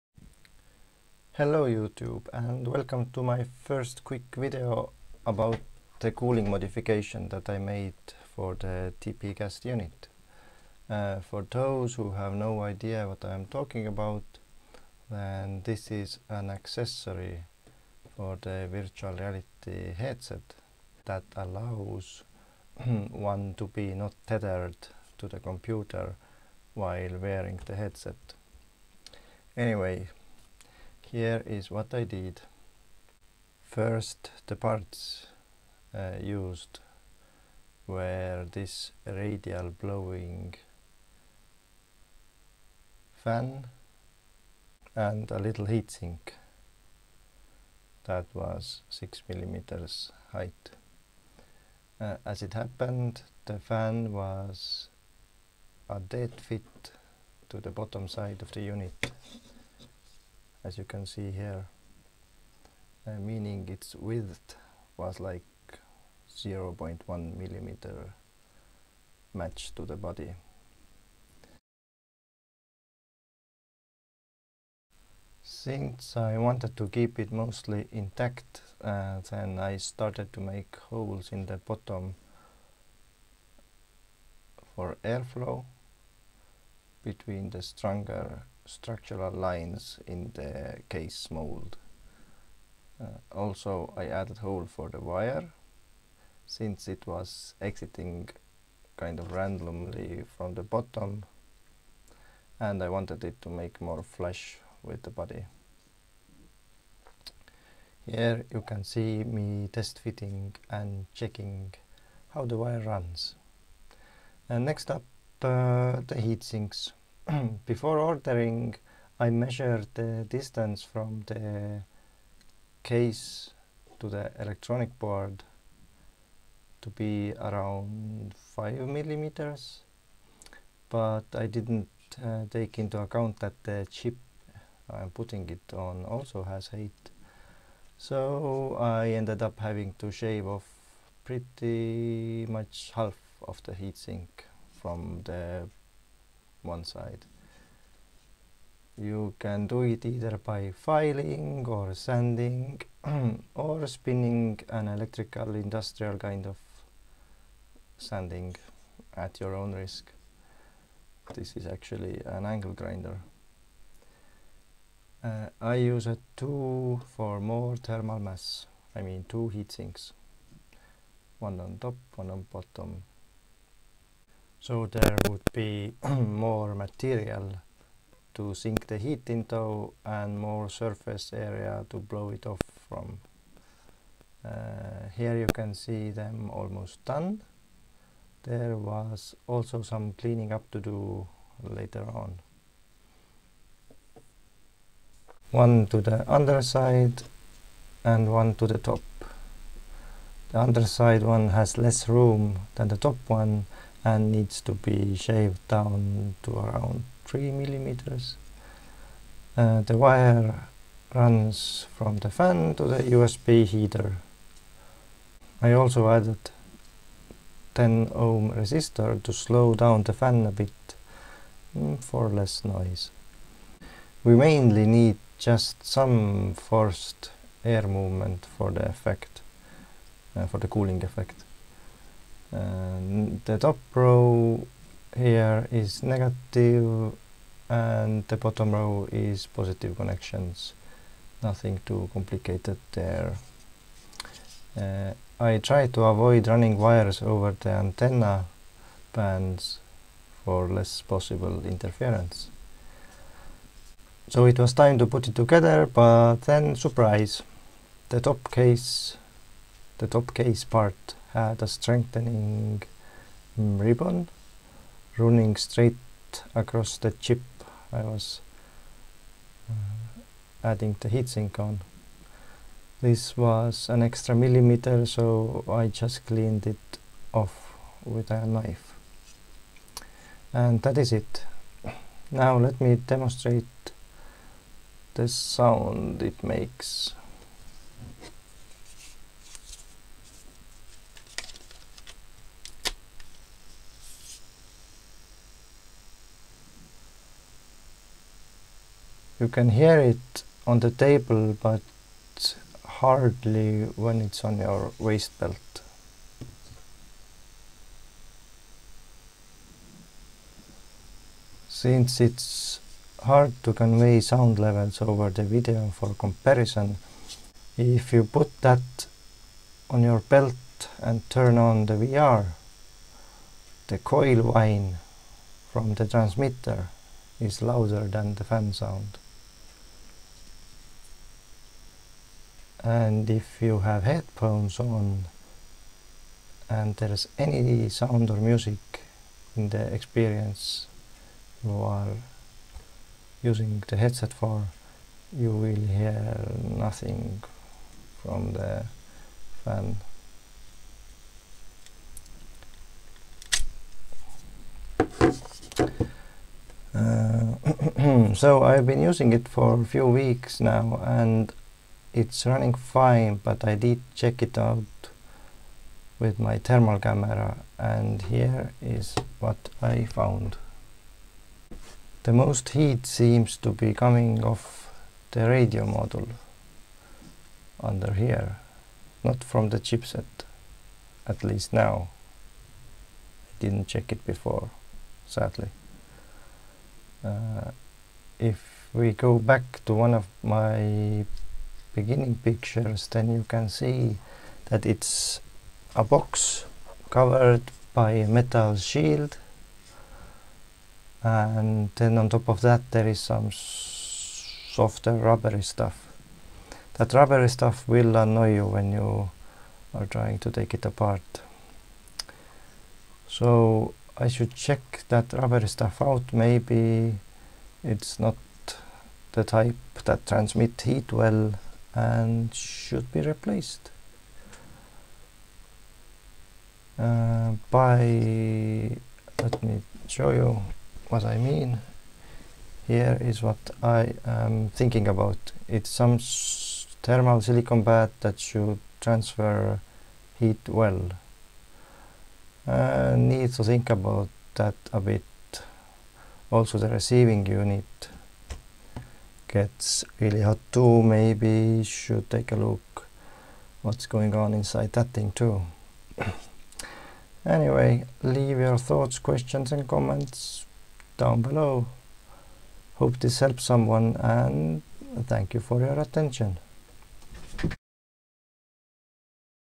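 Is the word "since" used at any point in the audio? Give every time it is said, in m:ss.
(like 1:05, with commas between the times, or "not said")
1:15, 1:36, 5:11.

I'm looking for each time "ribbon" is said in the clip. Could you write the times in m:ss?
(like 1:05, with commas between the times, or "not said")
4:23.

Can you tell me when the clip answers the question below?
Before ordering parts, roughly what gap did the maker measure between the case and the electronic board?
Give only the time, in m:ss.
2:08.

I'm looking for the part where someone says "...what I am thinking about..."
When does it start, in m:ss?
7:13.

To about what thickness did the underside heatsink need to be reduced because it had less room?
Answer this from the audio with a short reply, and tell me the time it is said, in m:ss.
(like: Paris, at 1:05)
3 millimeters, at 3:27.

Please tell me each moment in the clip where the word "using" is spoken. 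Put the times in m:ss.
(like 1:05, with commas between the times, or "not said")
5:43, 5:59.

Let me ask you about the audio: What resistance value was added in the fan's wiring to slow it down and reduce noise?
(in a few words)
10 ohm.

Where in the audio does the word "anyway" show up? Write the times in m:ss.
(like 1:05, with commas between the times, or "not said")
0:29, 7:37.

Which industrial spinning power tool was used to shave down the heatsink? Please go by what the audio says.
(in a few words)
angle grinder.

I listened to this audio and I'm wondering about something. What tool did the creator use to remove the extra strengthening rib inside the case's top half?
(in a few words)
a knife.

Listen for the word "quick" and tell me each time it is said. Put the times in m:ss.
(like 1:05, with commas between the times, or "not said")
0:04.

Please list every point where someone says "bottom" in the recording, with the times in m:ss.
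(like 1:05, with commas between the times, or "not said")
0:57, 1:21, 1:40, 2:52, 3:58.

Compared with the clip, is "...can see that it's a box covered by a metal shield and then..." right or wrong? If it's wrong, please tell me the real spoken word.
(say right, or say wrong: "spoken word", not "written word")
right.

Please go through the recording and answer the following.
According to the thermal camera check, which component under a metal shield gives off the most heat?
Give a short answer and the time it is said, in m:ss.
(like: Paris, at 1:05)
radio module, at 6:15.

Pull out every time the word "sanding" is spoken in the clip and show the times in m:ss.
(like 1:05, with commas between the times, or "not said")
2:31, 2:37.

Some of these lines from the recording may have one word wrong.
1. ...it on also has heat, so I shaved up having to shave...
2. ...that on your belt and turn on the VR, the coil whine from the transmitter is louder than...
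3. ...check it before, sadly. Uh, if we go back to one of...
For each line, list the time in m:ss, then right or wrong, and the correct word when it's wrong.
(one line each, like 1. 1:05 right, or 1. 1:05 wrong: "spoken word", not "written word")
1. 2:15 wrong: "ended", not "shaved"
2. 5:18 right
3. 6:23 right.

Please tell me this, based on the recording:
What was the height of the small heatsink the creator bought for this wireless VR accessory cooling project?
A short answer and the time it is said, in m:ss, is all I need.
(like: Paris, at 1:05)
6 millimeters, at 0:48.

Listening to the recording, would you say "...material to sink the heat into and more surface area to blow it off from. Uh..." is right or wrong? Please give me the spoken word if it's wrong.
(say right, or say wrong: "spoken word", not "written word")
right.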